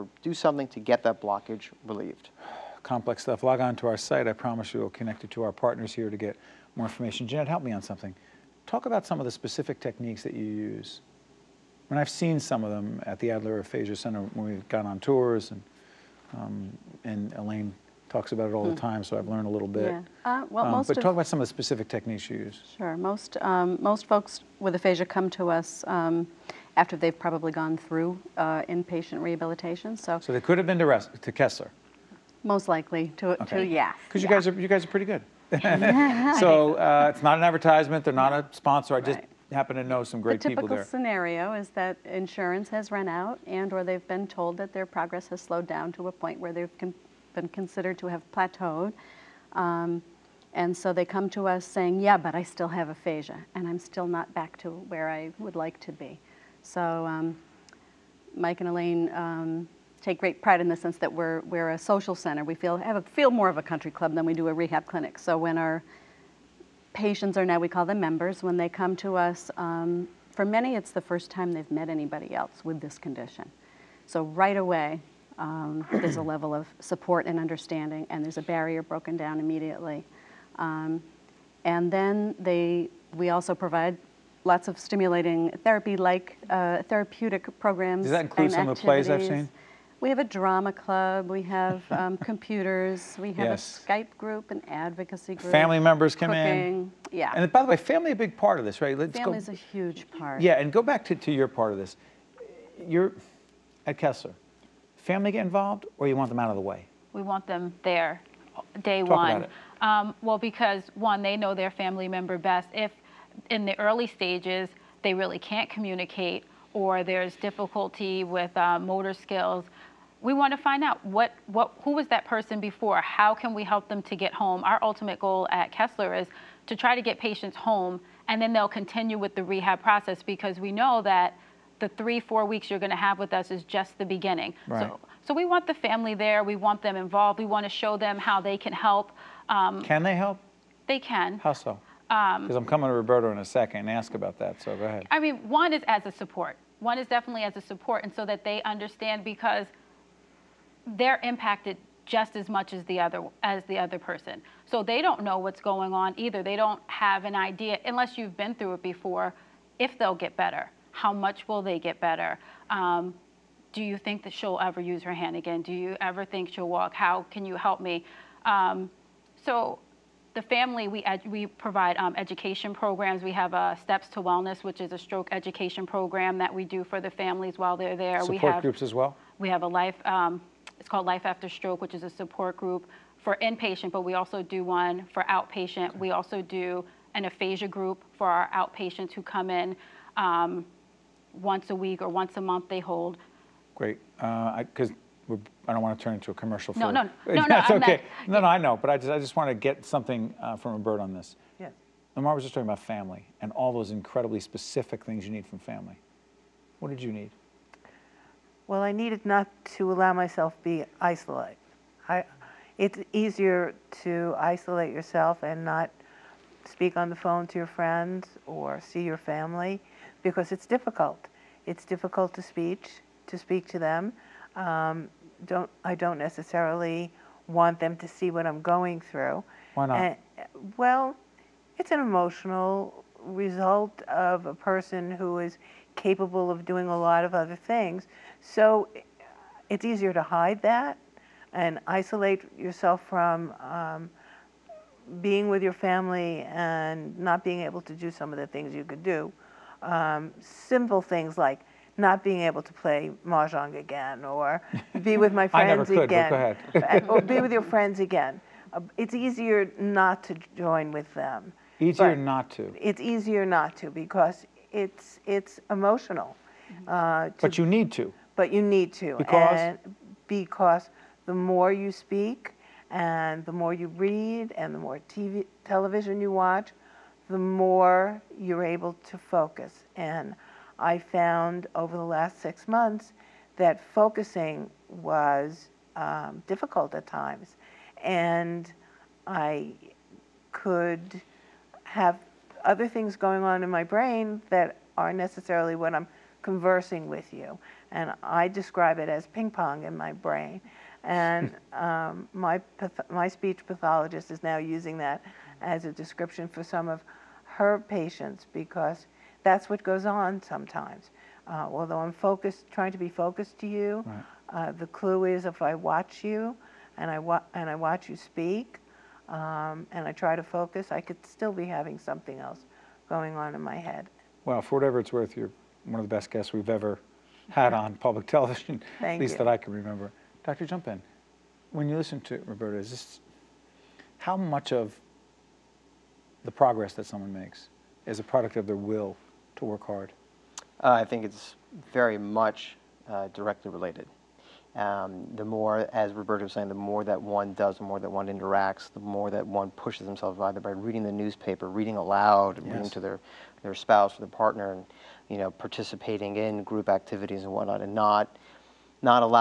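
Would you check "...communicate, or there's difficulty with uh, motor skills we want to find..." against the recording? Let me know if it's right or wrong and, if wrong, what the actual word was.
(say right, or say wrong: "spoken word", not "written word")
right.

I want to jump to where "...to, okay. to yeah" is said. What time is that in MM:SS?
00:33.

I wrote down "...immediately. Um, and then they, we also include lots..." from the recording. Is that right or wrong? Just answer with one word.
wrong.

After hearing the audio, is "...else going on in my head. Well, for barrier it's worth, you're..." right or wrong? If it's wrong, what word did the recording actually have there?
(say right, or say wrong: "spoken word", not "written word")
wrong: "whatever", not "barrier".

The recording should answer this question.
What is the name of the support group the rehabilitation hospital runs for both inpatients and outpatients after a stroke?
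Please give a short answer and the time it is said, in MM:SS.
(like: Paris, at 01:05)
Life After Stroke, at 03:01.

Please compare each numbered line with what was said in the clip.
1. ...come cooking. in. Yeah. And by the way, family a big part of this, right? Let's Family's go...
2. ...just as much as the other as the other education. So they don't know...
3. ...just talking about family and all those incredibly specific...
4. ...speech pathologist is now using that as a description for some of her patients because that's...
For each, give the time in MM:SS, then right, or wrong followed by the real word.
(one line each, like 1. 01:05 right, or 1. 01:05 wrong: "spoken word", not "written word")
1. 01:36 right
2. 02:32 wrong: "person", not "education"
3. 03:22 right
4. 05:03 right.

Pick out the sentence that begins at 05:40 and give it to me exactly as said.
Uh, I think it's very much uh, directly related.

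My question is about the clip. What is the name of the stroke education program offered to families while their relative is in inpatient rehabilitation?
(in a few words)
Steps to Wellness.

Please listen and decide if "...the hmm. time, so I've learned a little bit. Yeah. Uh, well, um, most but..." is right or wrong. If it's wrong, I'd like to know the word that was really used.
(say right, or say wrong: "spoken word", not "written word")
right.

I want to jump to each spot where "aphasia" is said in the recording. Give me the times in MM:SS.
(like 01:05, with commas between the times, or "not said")
00:13, 00:24, 00:52, 03:07.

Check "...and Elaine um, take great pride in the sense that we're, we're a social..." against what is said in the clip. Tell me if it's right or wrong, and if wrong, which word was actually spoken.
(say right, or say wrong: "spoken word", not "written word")
right.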